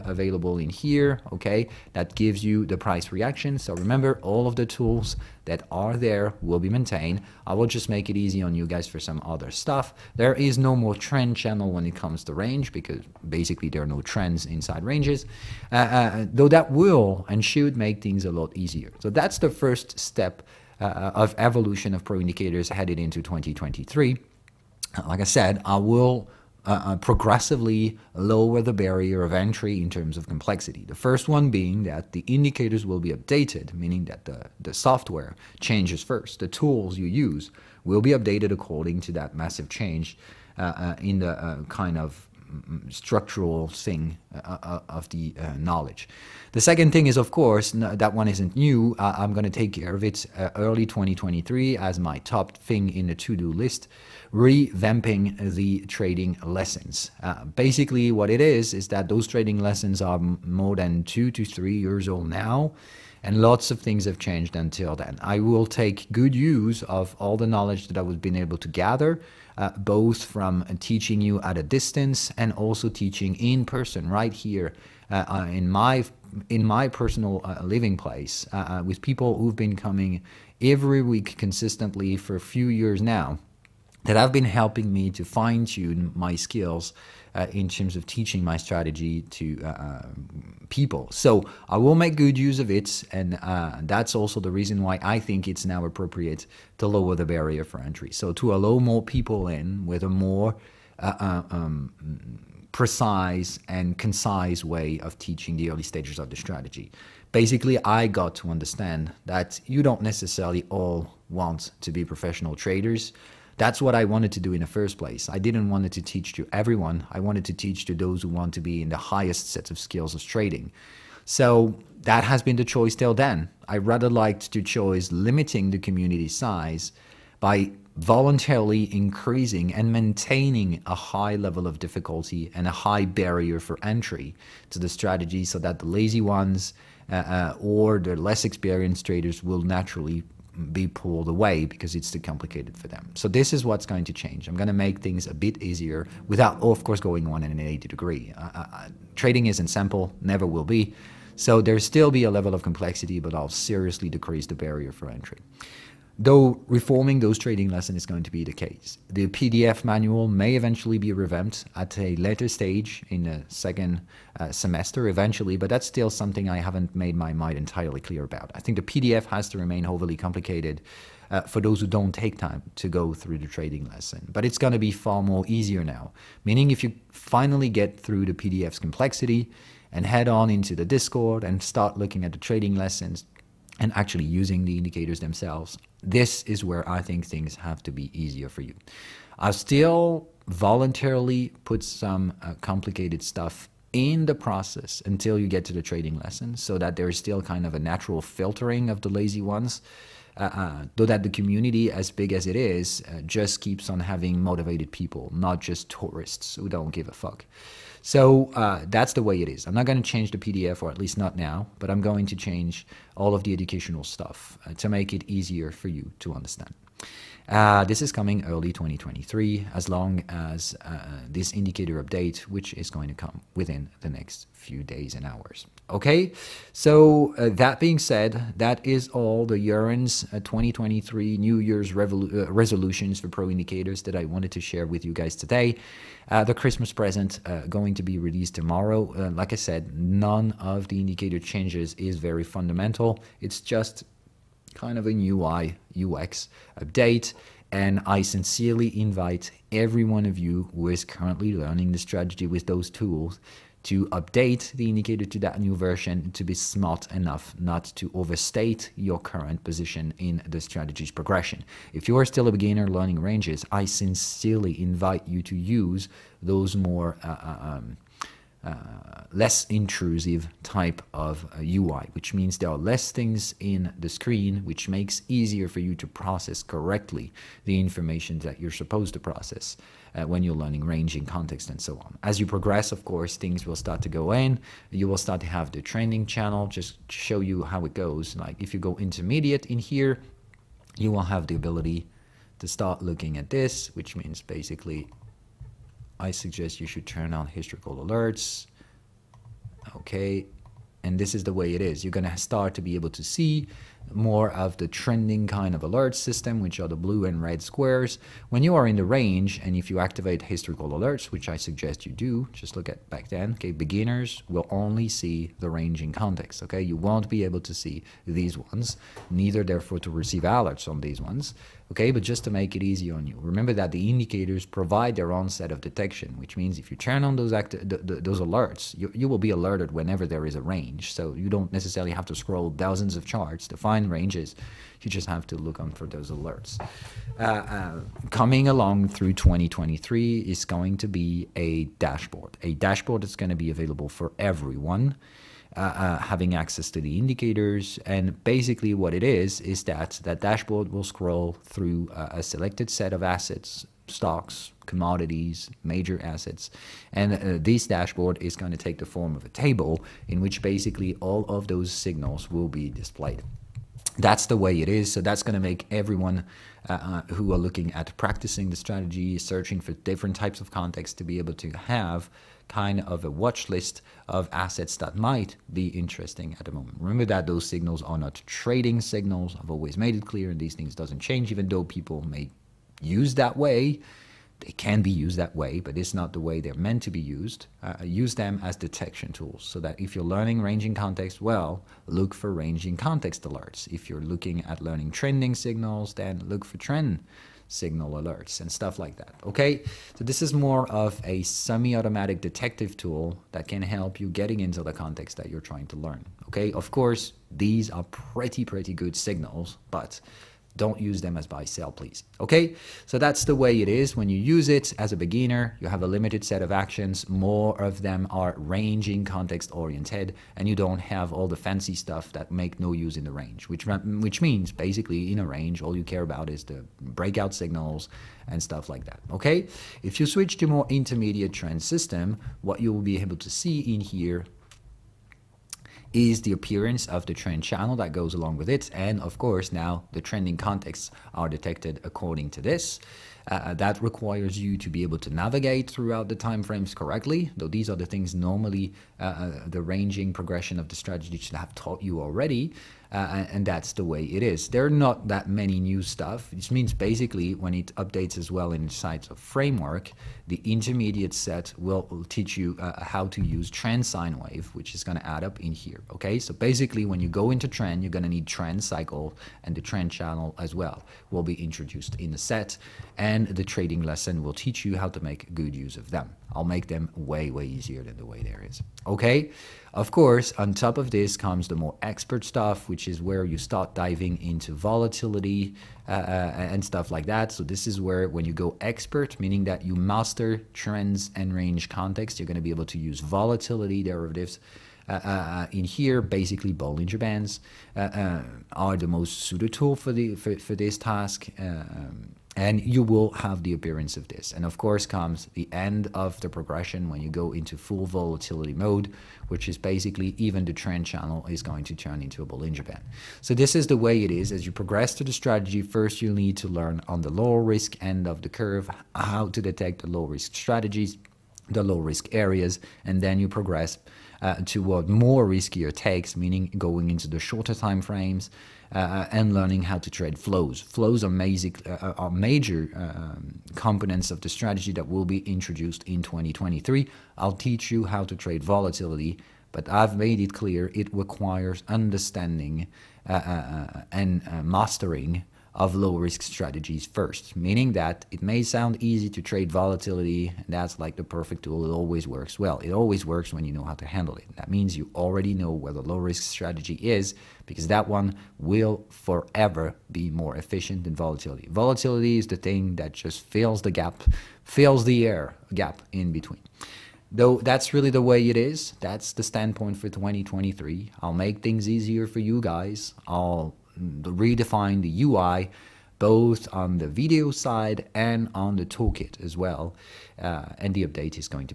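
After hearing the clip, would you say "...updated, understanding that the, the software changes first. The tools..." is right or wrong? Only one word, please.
wrong.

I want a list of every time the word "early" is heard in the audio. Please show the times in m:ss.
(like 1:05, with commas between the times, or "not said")
0:50, 1:45, 3:38.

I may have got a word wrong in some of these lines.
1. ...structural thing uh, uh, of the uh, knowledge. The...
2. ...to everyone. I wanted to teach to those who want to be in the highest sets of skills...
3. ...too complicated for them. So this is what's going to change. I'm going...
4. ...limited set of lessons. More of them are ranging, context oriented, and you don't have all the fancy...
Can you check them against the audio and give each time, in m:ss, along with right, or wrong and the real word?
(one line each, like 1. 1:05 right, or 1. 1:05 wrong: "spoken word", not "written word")
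1. 0:42 right
2. 1:56 right
3. 2:22 right
4. 6:56 wrong: "actions", not "lessons".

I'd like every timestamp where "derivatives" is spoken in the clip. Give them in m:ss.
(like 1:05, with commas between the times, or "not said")
8:14.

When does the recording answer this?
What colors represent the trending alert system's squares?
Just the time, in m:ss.
5:06.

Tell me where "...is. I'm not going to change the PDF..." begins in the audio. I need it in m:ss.
3:29.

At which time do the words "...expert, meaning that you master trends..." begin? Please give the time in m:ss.
8:08.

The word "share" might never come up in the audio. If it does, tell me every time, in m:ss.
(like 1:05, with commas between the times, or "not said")
3:54.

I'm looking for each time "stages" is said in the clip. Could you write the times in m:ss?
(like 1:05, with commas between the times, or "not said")
1:45, 2:42.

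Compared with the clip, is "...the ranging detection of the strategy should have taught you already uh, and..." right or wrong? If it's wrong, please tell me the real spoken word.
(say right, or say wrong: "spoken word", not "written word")
wrong: "progression", not "detection".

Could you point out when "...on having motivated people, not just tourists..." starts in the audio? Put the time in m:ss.
3:23.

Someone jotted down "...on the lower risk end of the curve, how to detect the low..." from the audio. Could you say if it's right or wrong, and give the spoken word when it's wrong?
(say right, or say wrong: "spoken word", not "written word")
right.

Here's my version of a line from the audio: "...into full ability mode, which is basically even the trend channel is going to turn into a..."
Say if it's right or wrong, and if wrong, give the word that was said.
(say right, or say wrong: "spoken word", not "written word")
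wrong: "volatility", not "ability".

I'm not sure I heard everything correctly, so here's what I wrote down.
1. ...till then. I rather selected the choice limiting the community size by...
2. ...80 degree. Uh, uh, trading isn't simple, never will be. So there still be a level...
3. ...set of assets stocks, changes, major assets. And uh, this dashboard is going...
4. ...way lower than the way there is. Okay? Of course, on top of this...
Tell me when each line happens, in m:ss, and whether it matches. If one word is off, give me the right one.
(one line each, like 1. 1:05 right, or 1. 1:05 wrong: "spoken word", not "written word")
1. 2:02 wrong: "liked", not "selected"
2. 2:27 right
3. 5:52 wrong: "commodities", not "changes"
4. 7:57 wrong: "easier", not "lower".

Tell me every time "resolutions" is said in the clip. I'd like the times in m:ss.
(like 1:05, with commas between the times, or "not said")
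3:52.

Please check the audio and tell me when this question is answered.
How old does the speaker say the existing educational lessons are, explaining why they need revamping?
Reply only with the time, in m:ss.
1:01.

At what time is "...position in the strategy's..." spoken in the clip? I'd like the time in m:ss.
4:19.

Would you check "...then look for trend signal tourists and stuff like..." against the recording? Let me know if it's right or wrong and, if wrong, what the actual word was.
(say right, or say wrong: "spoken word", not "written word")
wrong: "alerts", not "tourists".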